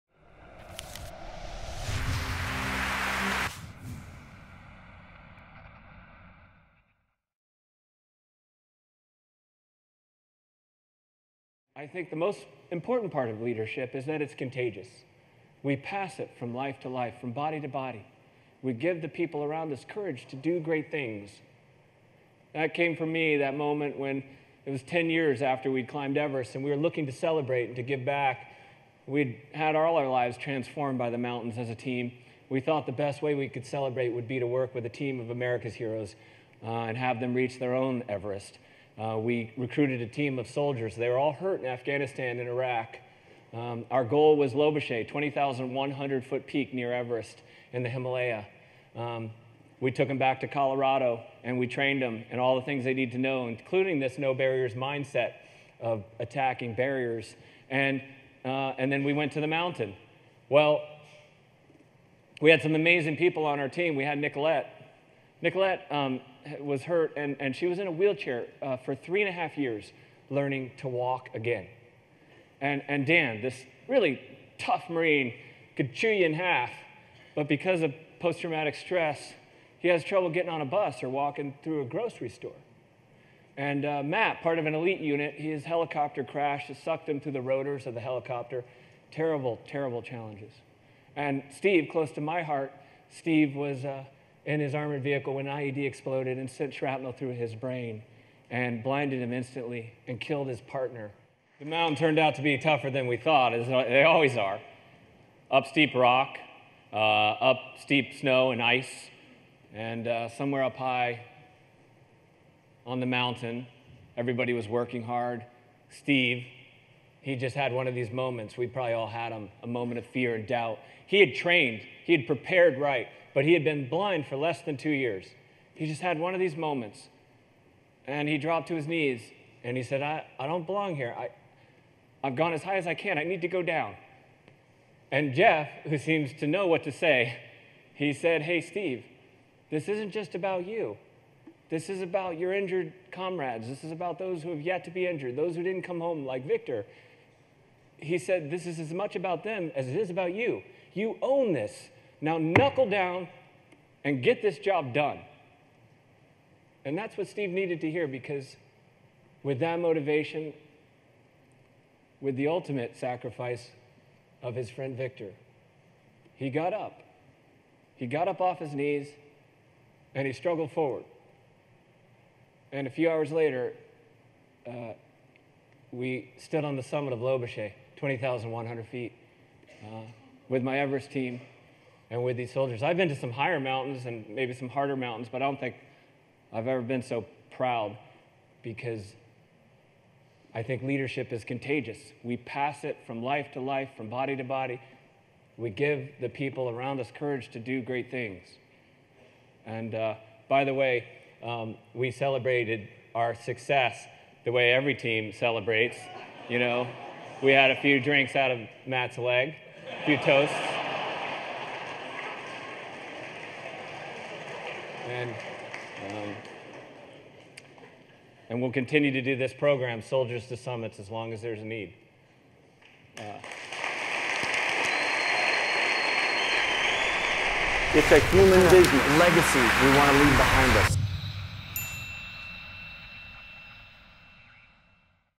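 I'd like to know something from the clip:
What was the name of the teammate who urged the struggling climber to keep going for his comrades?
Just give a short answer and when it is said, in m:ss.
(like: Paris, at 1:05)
Jeff, at 2:15.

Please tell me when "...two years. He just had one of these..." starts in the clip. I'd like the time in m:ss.
2:04.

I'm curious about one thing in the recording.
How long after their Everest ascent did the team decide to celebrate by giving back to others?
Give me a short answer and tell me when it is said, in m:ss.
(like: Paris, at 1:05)
10 years, at 0:24.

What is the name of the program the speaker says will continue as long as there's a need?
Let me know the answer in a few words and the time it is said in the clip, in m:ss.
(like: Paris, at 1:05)
Soldiers to Summits, at 3:40.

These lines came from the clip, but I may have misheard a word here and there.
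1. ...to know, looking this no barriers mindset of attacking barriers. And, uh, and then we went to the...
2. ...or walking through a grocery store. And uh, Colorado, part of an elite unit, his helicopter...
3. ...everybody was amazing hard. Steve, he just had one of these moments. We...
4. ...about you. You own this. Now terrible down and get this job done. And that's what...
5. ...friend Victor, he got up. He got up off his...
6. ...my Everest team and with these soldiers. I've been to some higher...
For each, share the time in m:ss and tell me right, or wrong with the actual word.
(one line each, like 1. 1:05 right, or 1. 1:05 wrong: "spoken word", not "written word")
1. 0:53 wrong: "including", not "looking"
2. 1:21 wrong: "Matt", not "Colorado"
3. 1:54 wrong: "working", not "amazing"
4. 2:30 wrong: "knuckle", not "terrible"
5. 2:44 right
6. 3:00 right.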